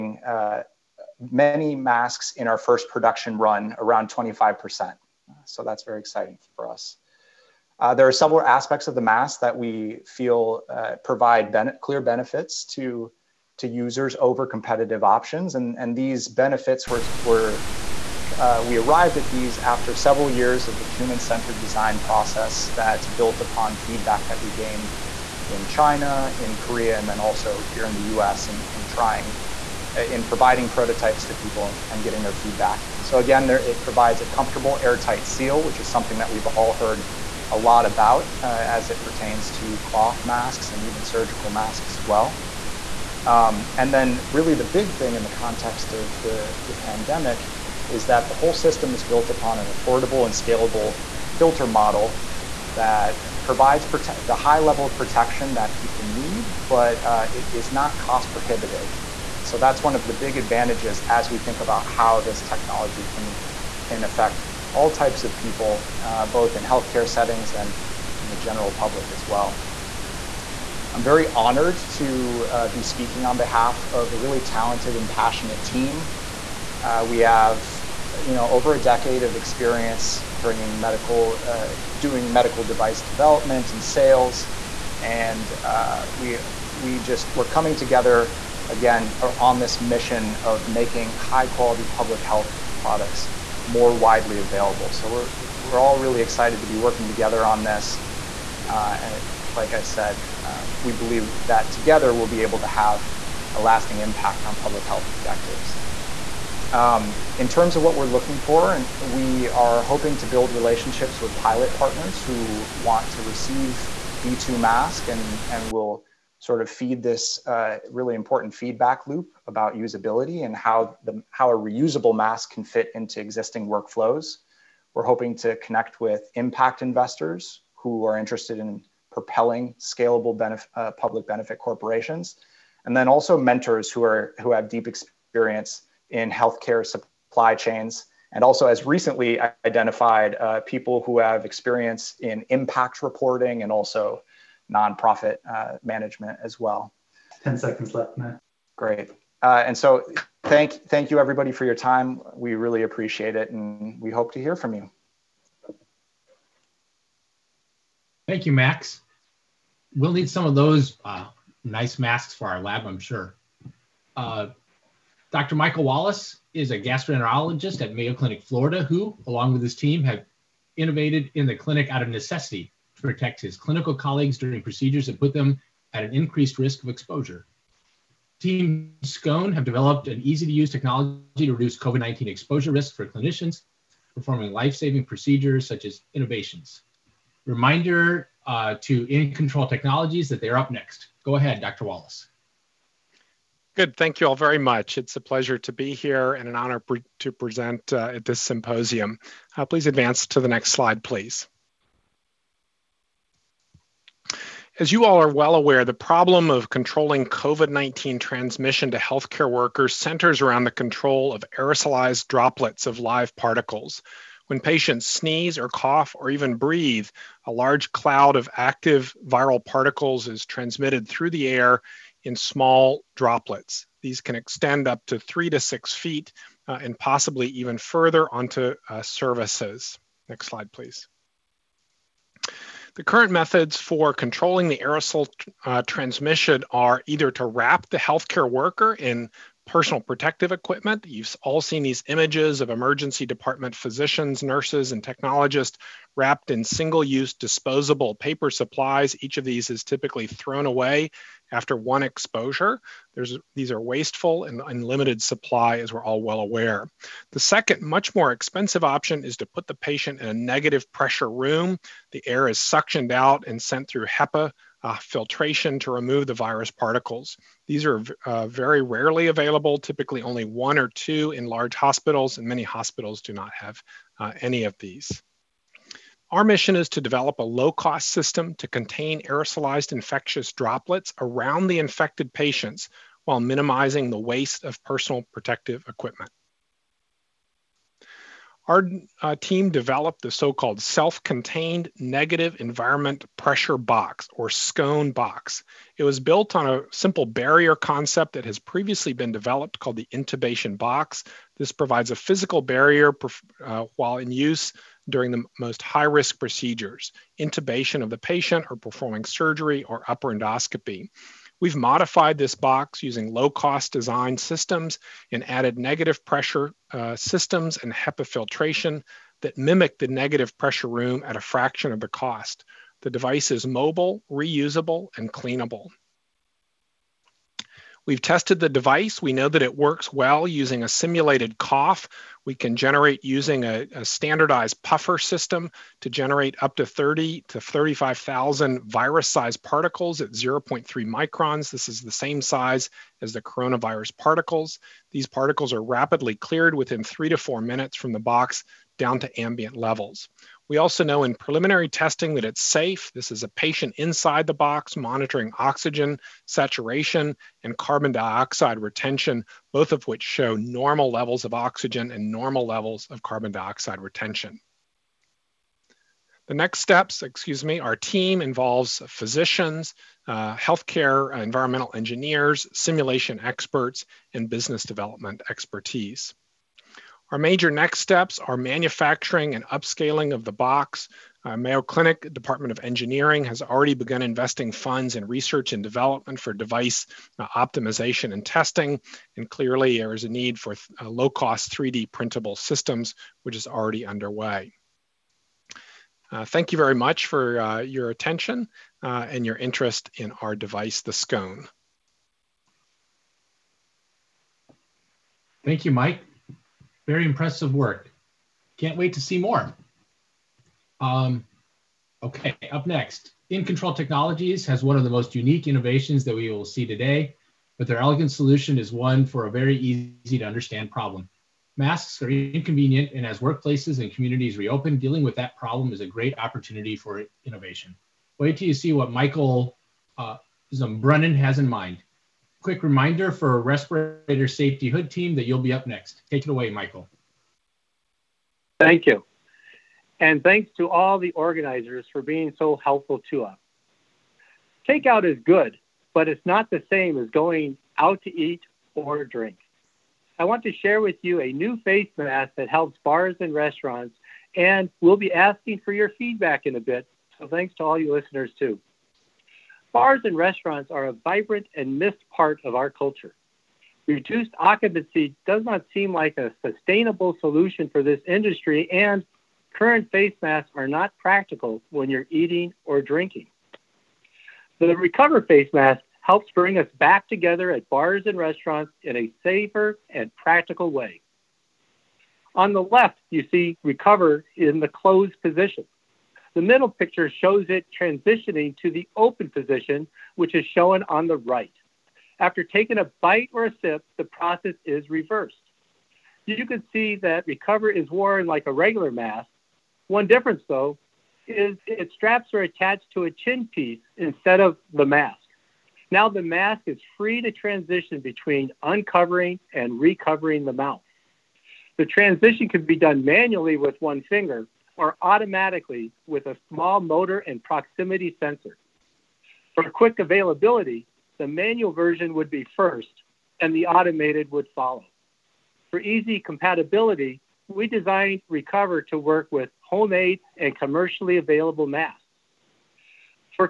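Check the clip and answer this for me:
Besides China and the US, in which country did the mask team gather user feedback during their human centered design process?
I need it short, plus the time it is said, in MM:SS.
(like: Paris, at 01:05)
Korea, at 00:26.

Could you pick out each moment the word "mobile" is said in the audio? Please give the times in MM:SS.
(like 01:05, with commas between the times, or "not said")
05:23.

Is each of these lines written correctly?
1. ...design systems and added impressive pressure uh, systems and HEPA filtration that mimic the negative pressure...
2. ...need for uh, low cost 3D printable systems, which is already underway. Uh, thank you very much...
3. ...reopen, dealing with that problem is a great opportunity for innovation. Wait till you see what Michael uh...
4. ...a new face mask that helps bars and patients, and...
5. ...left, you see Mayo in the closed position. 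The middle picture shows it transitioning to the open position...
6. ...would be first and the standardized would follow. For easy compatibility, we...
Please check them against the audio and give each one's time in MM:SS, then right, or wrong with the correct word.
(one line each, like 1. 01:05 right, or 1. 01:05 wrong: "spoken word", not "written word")
1. 05:13 wrong: "negative", not "impressive"
2. 06:30 right
3. 07:04 right
4. 07:31 wrong: "restaurants", not "patients"
5. 08:02 wrong: "Recover", not "Mayo"
6. 08:42 wrong: "automated", not "standardized".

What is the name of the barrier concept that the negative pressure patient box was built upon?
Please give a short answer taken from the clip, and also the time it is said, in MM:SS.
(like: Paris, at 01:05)
intubation box, at 05:00.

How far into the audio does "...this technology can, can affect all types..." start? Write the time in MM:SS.
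01:02.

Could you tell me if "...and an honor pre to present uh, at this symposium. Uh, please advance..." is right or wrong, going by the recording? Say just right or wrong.
right.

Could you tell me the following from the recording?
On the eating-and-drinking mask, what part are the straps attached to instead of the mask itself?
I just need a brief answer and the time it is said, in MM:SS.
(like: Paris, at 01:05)
a chin piece, at 08:23.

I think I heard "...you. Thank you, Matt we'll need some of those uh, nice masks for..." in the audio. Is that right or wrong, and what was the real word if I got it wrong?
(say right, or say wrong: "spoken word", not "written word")
wrong: "Max", not "Matt".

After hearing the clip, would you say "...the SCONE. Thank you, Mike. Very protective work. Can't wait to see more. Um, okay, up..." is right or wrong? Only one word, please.
wrong.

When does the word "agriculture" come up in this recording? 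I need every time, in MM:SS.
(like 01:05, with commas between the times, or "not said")
not said.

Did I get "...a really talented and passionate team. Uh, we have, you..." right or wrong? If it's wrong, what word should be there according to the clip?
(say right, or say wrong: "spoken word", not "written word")
right.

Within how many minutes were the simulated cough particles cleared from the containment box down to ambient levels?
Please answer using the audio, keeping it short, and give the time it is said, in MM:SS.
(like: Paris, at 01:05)
3 to 4 minutes, at 05:47.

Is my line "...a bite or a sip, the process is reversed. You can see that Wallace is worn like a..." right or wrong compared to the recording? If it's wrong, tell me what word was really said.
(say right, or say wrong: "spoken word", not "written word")
wrong: "Recover", not "Wallace".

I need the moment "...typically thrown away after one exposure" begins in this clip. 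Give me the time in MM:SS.
04:09.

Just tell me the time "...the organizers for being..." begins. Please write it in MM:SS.
07:21.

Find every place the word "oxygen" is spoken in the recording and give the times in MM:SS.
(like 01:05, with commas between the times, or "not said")
05:55, 06:01.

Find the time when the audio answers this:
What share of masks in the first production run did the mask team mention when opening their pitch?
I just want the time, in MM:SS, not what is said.
00:03.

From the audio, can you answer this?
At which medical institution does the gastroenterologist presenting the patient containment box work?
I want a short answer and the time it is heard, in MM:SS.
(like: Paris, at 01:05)
Mayo Clinic, Florida, at 02:47.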